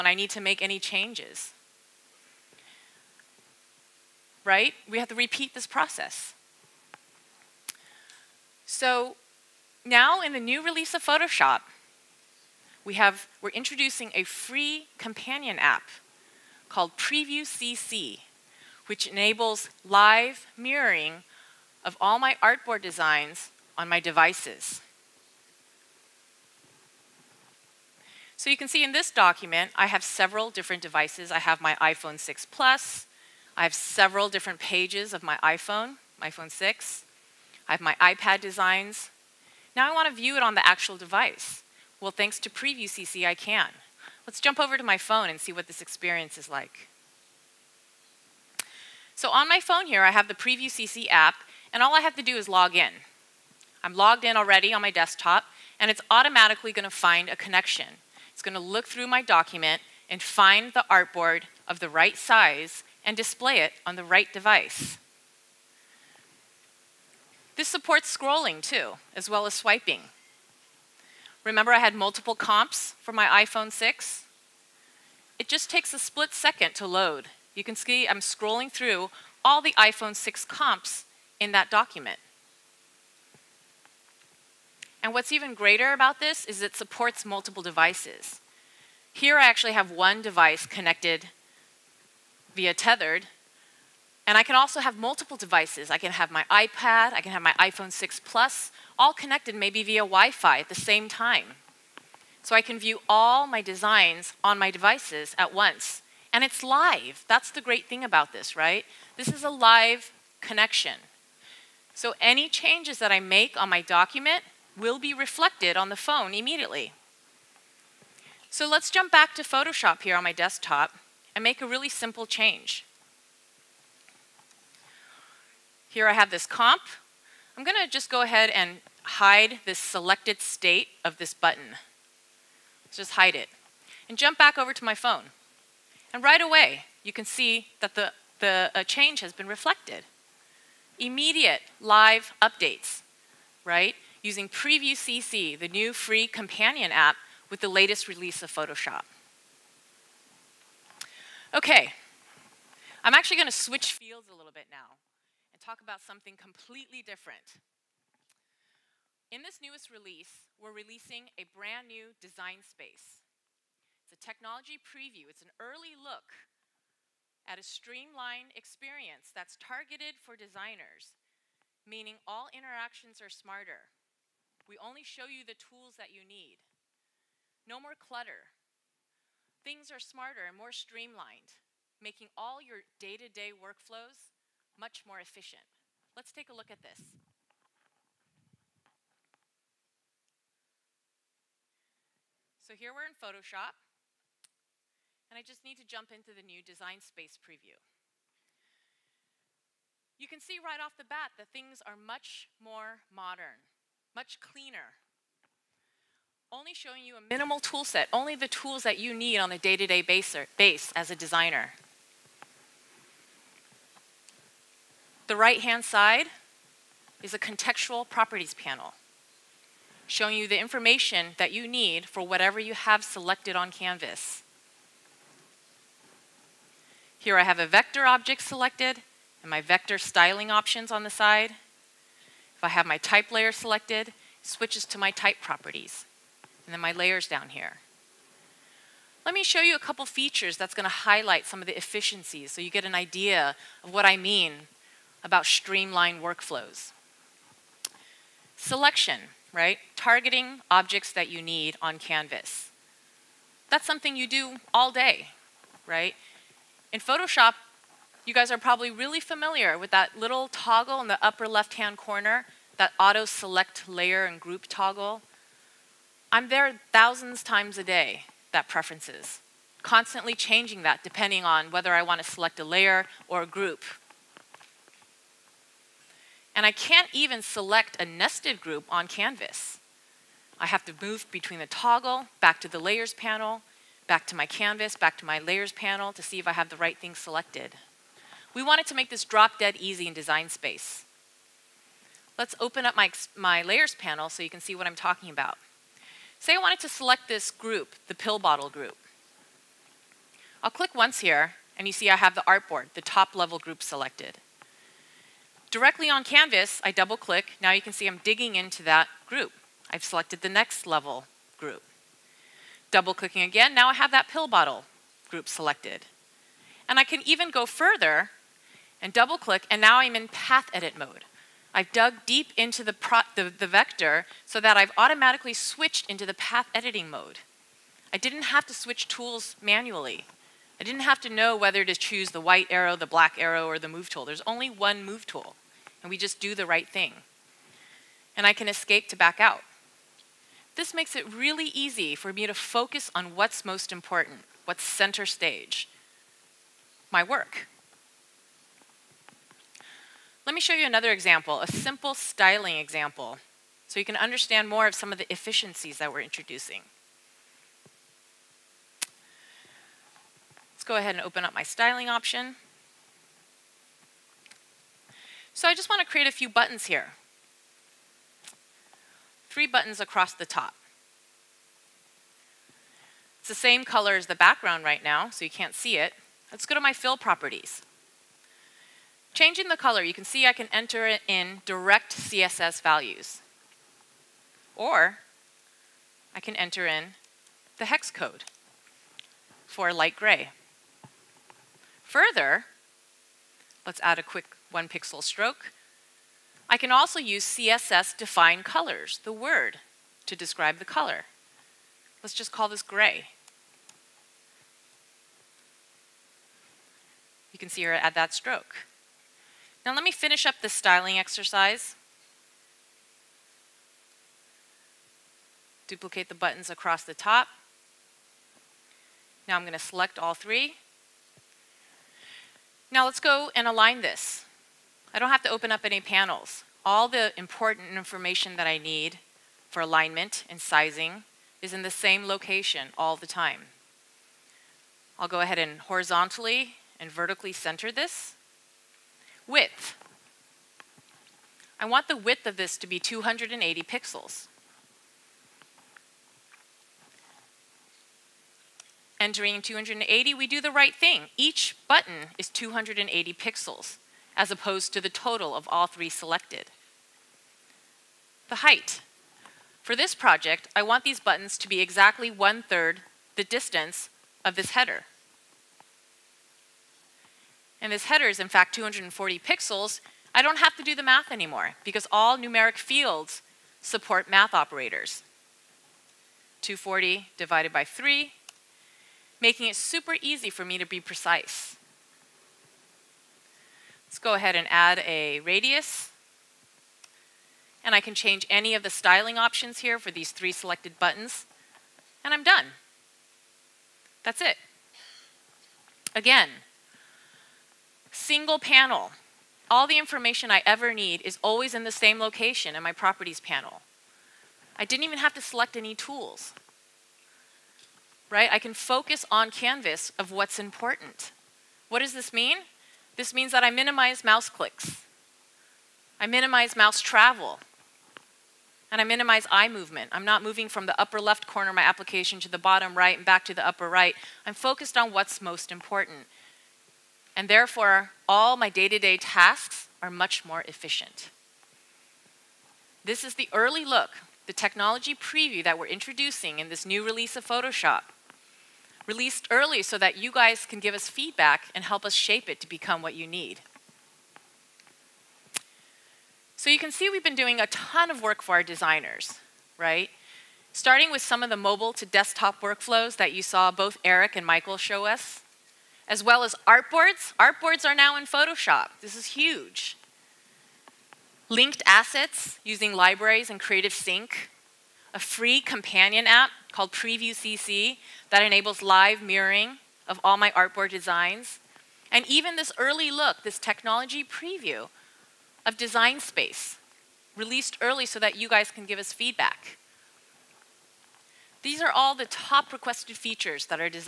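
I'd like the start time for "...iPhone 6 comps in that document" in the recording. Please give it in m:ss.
1:19.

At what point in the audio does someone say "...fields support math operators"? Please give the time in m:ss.
7:52.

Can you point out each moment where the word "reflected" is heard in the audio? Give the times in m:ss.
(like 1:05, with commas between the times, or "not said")
1:55, 2:19.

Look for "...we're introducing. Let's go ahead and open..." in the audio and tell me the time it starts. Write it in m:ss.
5:56.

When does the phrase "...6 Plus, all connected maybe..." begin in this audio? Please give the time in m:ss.
1:37.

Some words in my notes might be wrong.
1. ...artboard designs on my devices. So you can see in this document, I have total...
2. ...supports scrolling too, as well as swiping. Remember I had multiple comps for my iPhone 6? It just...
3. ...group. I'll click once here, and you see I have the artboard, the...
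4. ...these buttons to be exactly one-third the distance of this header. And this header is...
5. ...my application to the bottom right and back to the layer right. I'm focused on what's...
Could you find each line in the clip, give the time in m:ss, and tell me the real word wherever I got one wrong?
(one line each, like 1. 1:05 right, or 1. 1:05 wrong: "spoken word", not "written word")
1. 0:22 wrong: "several", not "total"
2. 1:07 right
3. 4:58 right
4. 7:41 right
5. 8:41 wrong: "upper", not "layer".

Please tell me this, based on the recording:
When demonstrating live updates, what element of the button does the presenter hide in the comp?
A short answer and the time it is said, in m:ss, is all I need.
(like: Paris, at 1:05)
selected state, at 2:09.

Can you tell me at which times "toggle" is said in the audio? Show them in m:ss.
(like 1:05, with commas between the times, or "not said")
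4:20, 4:24, 4:41.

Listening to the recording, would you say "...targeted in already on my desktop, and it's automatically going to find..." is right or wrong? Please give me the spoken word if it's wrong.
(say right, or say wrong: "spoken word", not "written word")
wrong: "logged", not "targeted".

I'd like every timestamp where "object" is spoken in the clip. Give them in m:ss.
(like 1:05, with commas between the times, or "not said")
3:48, 4:10.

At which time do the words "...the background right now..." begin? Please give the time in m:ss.
6:14.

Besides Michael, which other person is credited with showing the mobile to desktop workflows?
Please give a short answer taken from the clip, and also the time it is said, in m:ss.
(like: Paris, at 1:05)
Eric, at 9:14.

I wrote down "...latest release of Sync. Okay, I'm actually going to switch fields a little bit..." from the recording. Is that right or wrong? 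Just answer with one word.
wrong.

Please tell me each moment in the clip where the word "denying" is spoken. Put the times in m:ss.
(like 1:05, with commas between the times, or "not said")
not said.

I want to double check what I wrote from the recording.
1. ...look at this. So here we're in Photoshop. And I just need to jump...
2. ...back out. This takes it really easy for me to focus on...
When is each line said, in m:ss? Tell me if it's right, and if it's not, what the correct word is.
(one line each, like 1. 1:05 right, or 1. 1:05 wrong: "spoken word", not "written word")
1. 3:06 right
2. 5:39 wrong: "makes", not "takes".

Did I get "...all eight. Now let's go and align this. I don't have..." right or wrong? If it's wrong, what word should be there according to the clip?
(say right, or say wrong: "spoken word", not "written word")
wrong: "three", not "eight".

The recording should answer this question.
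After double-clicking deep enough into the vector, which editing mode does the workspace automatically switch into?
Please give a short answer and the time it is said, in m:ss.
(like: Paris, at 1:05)
path edit mode, at 5:20.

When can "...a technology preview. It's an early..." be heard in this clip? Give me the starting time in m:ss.
2:44.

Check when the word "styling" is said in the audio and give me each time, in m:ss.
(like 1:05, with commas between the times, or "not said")
3:49, 5:52, 6:01, 6:50, 8:08.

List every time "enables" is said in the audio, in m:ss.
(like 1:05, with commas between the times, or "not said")
0:19, 9:28.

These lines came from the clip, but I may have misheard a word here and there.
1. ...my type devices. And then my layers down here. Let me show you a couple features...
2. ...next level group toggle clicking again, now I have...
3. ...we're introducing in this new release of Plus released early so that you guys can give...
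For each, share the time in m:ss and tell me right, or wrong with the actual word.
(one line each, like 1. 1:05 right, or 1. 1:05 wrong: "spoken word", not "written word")
1. 3:54 wrong: "properties", not "devices"
2. 5:10 wrong: "double", not "toggle"
3. 8:55 wrong: "Photoshop", not "Plus".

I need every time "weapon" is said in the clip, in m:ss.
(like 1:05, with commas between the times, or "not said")
not said.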